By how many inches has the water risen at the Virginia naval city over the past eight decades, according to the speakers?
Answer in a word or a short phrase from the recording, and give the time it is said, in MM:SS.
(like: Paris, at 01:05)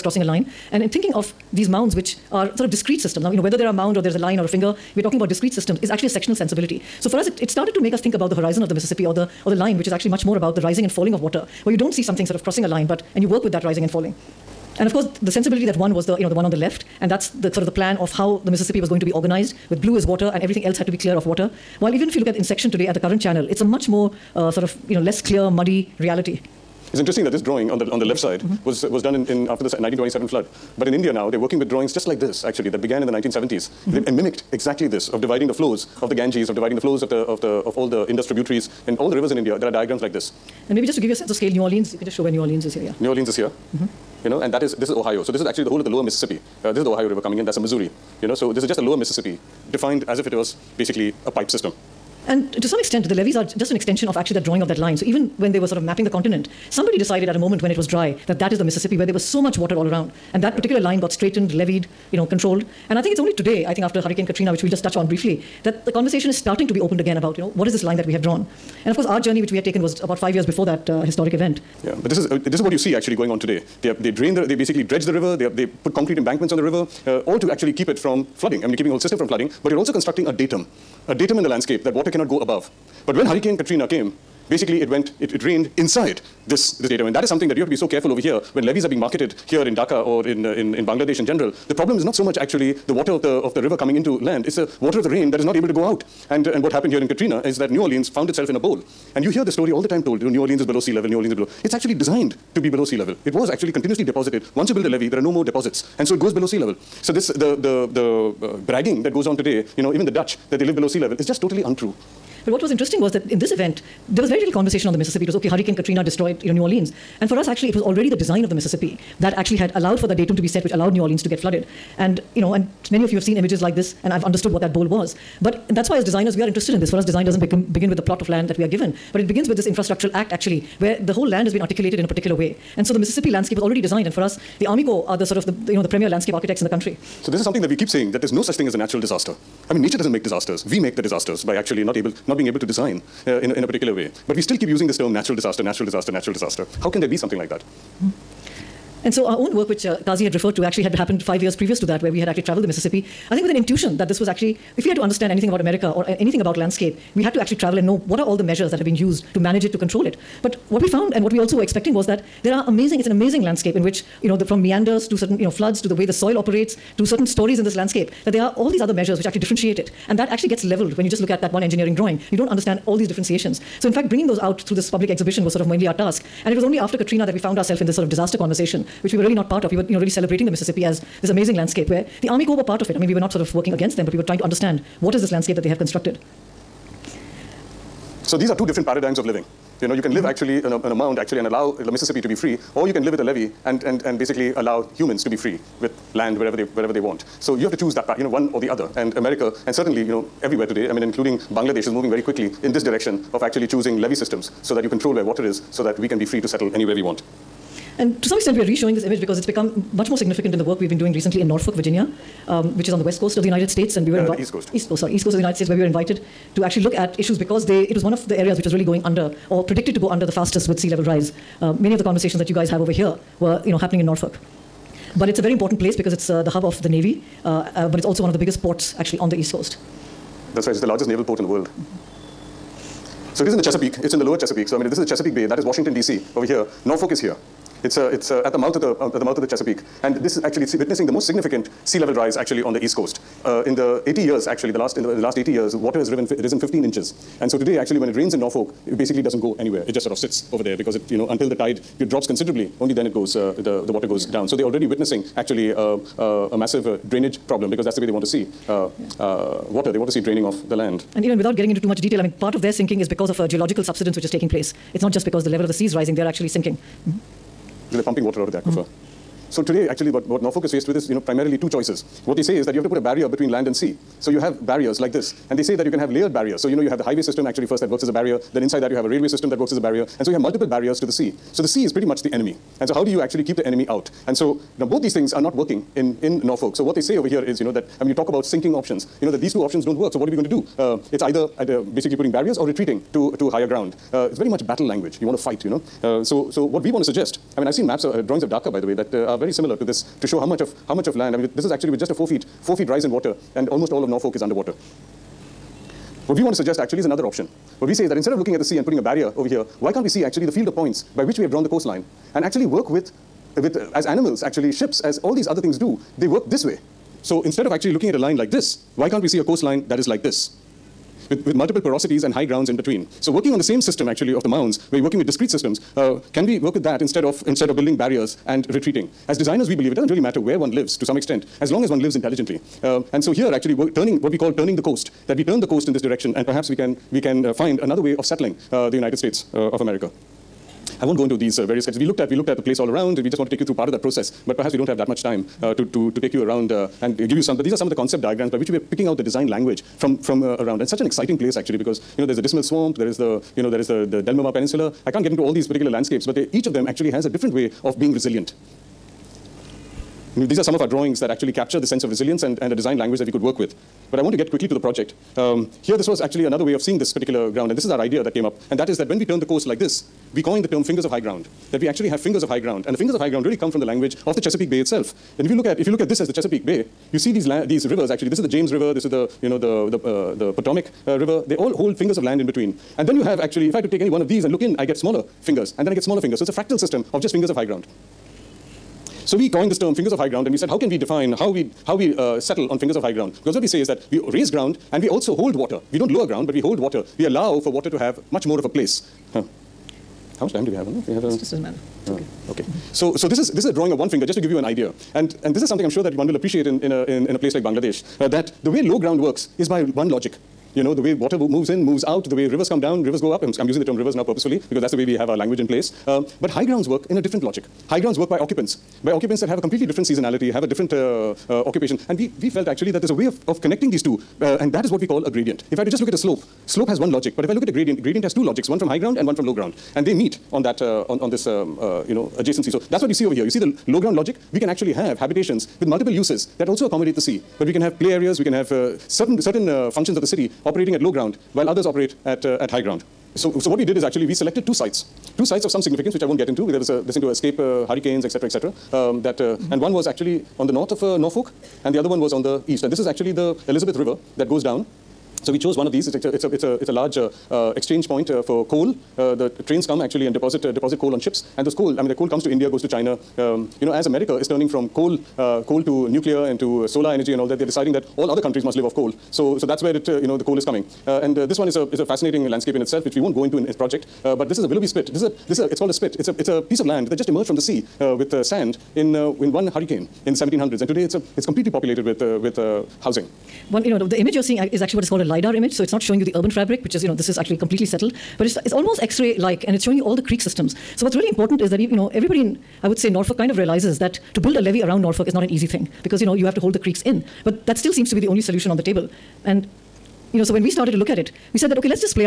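15 inches, at 04:06.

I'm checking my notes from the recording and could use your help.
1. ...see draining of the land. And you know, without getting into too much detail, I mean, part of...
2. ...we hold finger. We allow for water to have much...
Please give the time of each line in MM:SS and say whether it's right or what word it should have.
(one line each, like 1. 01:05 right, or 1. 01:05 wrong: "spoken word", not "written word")
1. 04:20 right
2. 06:36 wrong: "water", not "finger".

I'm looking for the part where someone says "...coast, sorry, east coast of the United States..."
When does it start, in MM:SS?
03:34.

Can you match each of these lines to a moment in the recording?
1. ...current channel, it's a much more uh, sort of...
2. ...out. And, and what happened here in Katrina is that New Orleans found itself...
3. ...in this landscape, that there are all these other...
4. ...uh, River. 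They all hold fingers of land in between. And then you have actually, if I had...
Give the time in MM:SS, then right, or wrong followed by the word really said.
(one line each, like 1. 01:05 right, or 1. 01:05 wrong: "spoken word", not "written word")
1. 00:22 right
2. 01:35 right
3. 02:47 right
4. 06:21 right.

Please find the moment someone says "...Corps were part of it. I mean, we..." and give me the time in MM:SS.
03:02.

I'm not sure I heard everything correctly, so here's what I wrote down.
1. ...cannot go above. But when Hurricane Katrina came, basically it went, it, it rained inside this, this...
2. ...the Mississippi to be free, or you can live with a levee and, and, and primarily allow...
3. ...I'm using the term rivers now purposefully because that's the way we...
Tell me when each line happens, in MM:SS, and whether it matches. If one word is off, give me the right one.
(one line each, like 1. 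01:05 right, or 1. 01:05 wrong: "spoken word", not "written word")
1. 01:22 right
2. 03:11 wrong: "basically", not "primarily"
3. 06:53 right.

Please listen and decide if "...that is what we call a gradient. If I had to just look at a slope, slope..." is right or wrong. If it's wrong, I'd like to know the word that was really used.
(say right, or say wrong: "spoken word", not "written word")
right.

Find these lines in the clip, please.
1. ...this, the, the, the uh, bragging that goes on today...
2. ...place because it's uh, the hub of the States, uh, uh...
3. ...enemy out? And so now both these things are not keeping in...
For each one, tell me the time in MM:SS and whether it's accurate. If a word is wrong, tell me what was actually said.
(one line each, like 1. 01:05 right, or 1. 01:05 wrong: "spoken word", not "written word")
1. 01:47 right
2. 03:45 wrong: "Navy", not "States"
3. 04:43 wrong: "working", not "keeping".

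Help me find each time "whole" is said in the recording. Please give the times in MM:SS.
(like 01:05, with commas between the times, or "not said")
00:45, 01:18, 02:11.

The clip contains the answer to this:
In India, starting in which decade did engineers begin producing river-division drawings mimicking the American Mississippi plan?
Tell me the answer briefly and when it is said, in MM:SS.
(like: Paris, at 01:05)
1970s, at 00:33.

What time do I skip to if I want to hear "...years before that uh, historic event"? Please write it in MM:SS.
01:10.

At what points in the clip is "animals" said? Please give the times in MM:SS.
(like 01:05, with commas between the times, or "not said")
05:14.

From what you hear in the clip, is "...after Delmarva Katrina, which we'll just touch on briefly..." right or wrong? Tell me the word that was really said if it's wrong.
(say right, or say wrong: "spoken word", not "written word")
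wrong: "Hurricane", not "Delmarva".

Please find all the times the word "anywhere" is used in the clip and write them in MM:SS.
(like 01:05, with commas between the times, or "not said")
03:26, 04:09.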